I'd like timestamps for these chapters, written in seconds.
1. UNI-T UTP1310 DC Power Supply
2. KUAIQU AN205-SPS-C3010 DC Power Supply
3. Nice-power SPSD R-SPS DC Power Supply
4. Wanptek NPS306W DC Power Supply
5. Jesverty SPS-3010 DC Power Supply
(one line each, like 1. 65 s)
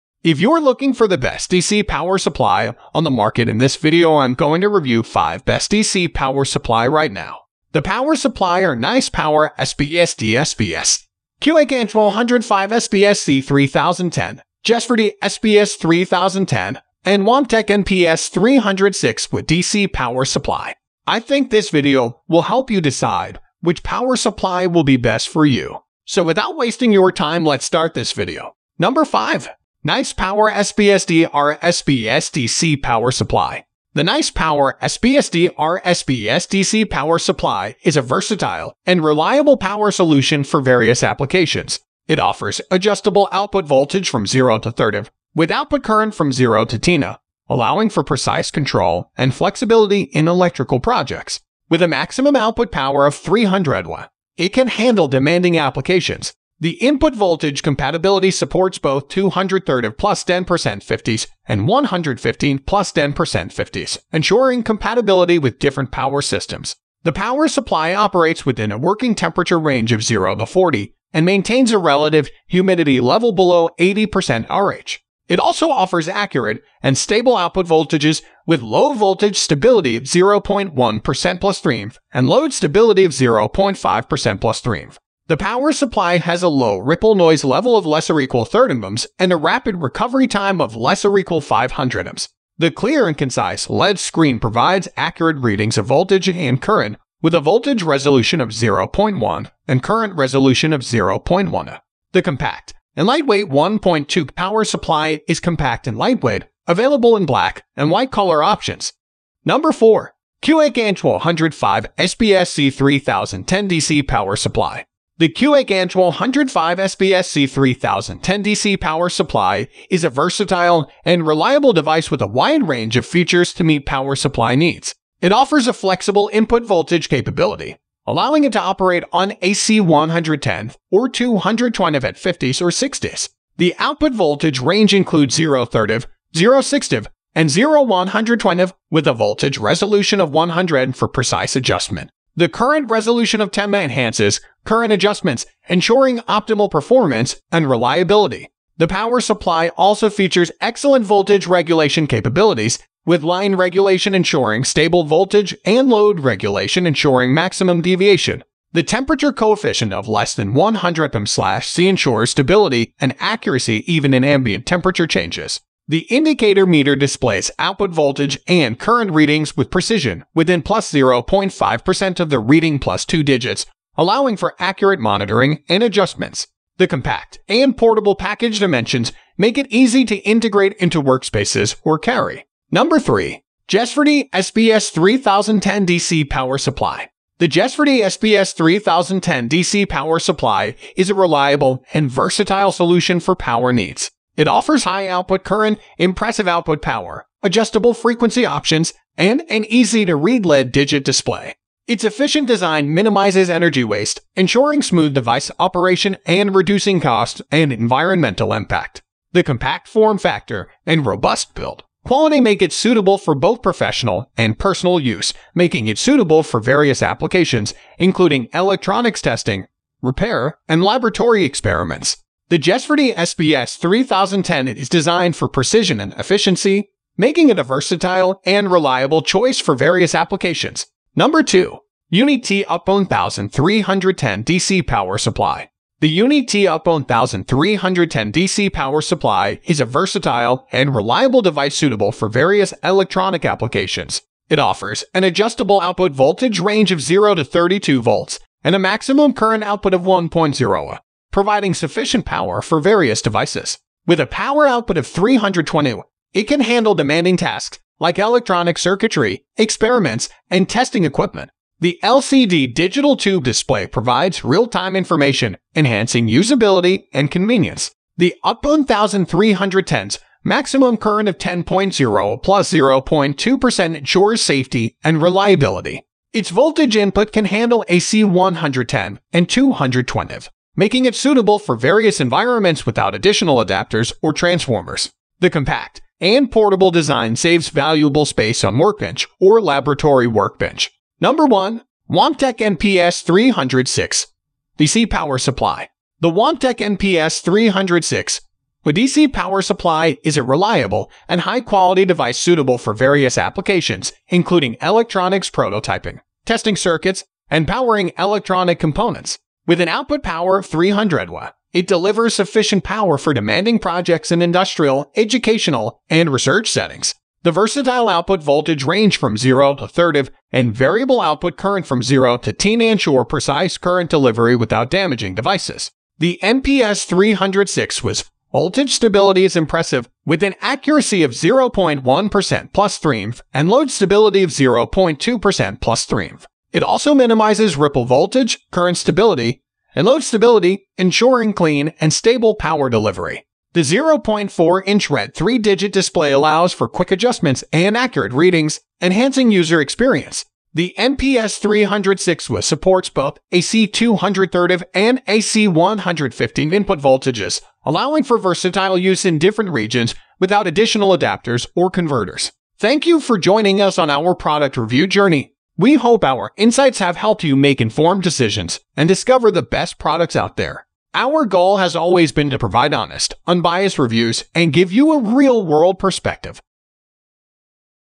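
1. 234 s
2. 115 s
3. 33 s
4. 295 s
5. 186 s.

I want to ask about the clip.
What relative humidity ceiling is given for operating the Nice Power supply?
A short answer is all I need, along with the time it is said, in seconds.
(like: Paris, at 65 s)
80%, at 73 s.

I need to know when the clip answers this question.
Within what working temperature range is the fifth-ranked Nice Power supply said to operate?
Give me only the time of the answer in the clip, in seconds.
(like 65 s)
70 s.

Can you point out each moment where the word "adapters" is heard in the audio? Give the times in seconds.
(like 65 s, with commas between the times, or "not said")
283 s, 361 s.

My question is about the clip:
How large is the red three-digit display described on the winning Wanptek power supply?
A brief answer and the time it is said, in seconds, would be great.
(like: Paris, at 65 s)
0.4-inch, at 343 s.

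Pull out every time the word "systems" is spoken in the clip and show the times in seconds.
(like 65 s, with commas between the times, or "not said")
66 s.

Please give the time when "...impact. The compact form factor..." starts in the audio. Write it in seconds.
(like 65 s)
208 s.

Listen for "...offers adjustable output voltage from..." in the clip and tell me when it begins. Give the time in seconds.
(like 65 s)
42 s.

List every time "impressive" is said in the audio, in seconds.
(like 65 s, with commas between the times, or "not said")
195 s, 329 s.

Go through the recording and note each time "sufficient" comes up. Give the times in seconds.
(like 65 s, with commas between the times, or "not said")
251 s, 312 s.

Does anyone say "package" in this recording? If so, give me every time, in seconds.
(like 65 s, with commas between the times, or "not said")
178 s.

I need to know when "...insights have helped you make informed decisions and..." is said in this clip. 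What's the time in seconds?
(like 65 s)
366 s.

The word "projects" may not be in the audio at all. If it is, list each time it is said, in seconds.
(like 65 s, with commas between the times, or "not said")
50 s, 313 s.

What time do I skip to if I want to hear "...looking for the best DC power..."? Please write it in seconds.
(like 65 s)
0 s.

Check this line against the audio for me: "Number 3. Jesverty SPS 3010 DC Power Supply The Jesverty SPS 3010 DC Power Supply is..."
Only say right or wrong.
right.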